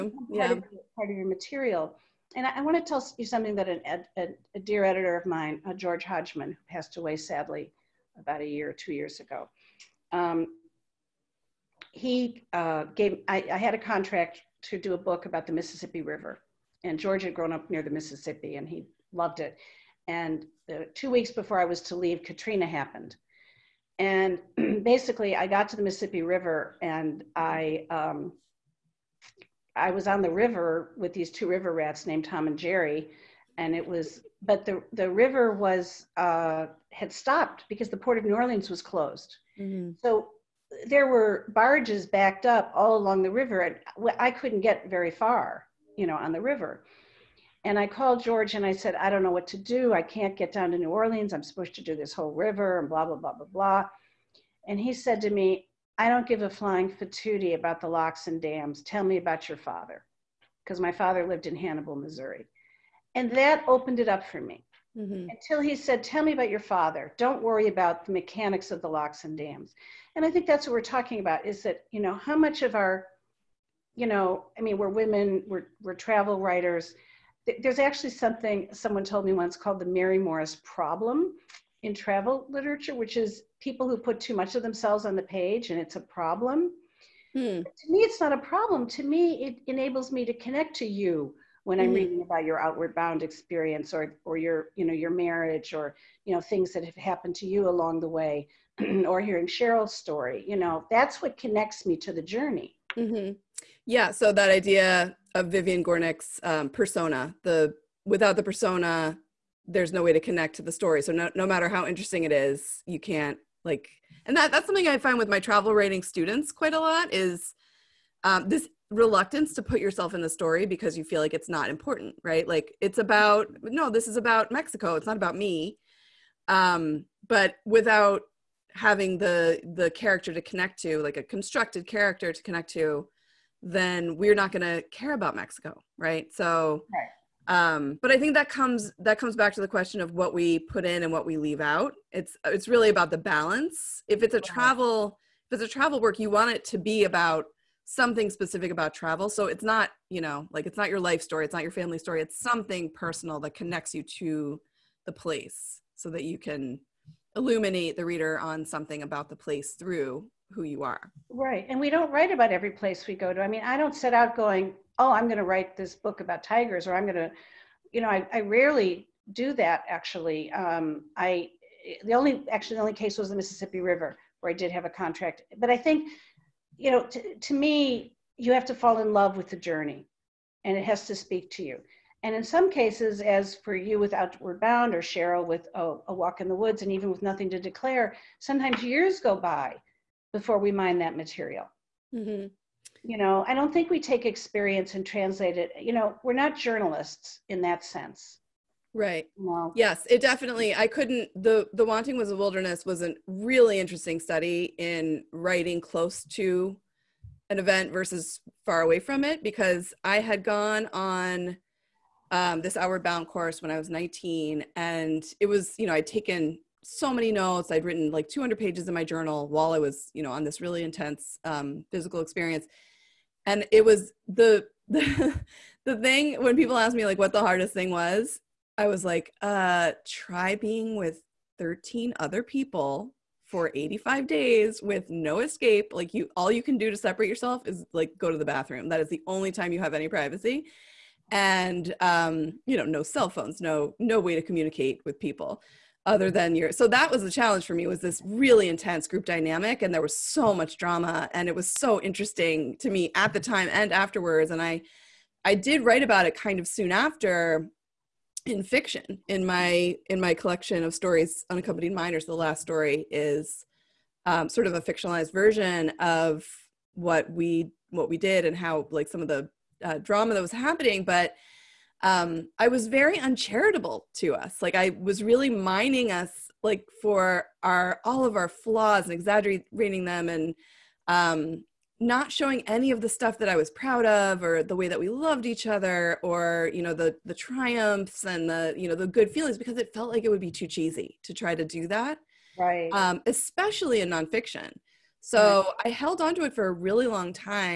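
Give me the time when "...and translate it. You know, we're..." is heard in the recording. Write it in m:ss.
3:14.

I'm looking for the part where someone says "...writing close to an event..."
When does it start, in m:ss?
3:25.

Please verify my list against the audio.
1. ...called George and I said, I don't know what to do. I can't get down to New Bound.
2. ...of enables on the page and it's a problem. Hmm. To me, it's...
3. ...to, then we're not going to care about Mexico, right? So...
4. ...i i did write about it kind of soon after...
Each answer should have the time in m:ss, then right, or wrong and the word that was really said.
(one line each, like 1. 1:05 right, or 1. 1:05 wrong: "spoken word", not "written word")
1. 0:47 wrong: "Orleans", not "Bound"
2. 1:24 wrong: "themselves", not "enables"
3. 2:12 right
4. 4:14 right.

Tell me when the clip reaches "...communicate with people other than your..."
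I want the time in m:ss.
4:04.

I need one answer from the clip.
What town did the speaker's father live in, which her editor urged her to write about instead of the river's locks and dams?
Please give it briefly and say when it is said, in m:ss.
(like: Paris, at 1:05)
Hannibal, Missouri, at 1:01.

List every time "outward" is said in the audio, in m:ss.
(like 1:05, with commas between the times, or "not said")
1:32, 3:04, 3:32.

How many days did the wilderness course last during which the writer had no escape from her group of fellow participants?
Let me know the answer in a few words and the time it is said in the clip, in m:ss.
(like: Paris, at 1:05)
85, at 3:53.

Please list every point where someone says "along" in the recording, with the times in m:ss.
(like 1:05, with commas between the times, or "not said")
0:42, 1:37.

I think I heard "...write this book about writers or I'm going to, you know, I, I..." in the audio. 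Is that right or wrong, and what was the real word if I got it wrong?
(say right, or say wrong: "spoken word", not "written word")
wrong: "tigers", not "writers".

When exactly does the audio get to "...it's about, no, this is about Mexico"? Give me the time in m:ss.
2:02.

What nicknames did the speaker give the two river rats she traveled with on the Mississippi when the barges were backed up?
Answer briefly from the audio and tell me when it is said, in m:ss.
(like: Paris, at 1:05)
Tom and Jerry, at 0:32.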